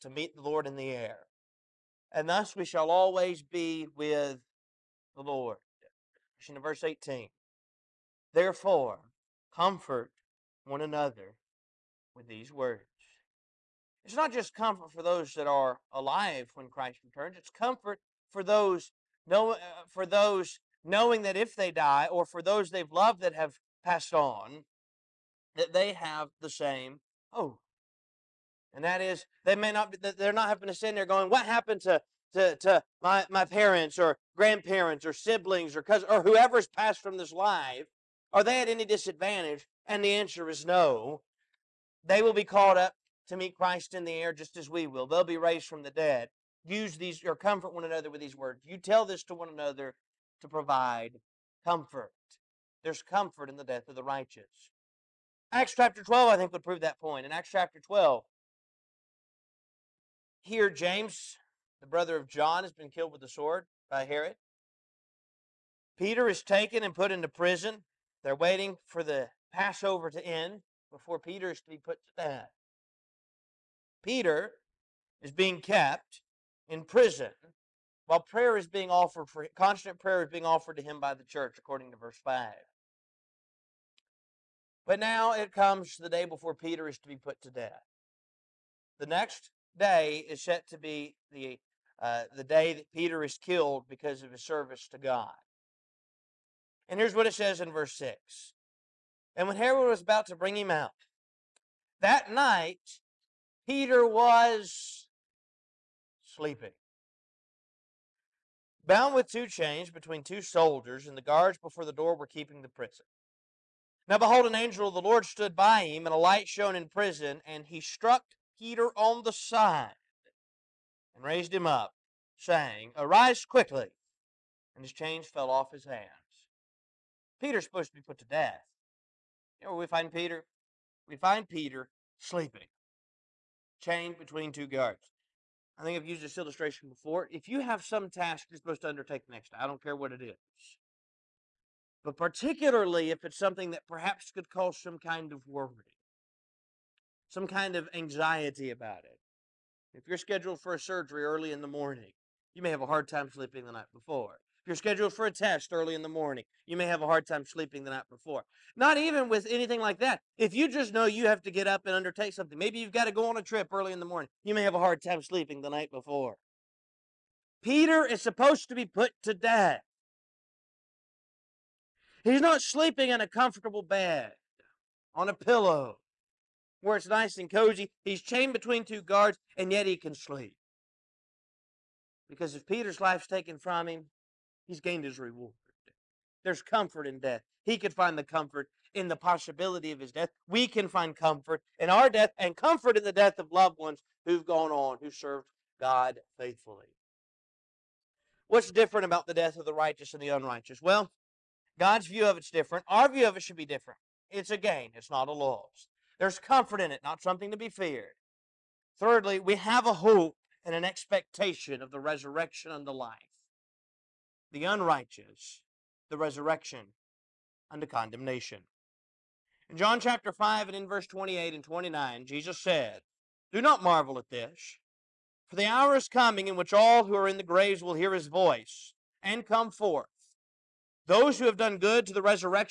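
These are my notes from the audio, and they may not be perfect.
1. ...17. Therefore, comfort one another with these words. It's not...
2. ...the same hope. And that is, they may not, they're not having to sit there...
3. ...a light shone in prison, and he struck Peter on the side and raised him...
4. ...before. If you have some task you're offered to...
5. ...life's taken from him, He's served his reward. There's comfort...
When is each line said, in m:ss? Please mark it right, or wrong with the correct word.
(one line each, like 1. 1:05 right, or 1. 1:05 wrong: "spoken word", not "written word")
1. 0:06 wrong: "18", not "17"
2. 0:26 right
3. 1:56 right
4. 2:16 wrong: "supposed", not "offered"
5. 3:03 wrong: "gained", not "served".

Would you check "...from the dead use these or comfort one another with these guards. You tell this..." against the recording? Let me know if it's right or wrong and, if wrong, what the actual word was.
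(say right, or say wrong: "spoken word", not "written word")
wrong: "words", not "guards".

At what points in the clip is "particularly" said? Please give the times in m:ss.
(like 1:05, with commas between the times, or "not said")
2:22.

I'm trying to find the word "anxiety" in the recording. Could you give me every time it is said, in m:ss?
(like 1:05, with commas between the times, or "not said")
2:27.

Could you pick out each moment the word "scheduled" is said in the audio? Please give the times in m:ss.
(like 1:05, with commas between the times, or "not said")
2:30, 2:34.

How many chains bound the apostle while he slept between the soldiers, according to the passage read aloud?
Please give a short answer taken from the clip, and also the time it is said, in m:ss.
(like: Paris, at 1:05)
2, at 1:49.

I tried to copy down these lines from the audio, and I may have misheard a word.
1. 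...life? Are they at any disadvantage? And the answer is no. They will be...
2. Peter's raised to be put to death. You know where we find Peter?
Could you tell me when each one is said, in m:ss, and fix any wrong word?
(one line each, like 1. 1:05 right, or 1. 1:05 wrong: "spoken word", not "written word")
1. 0:37 right
2. 2:07 wrong: "supposed", not "raised".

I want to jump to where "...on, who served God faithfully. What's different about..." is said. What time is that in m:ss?
3:14.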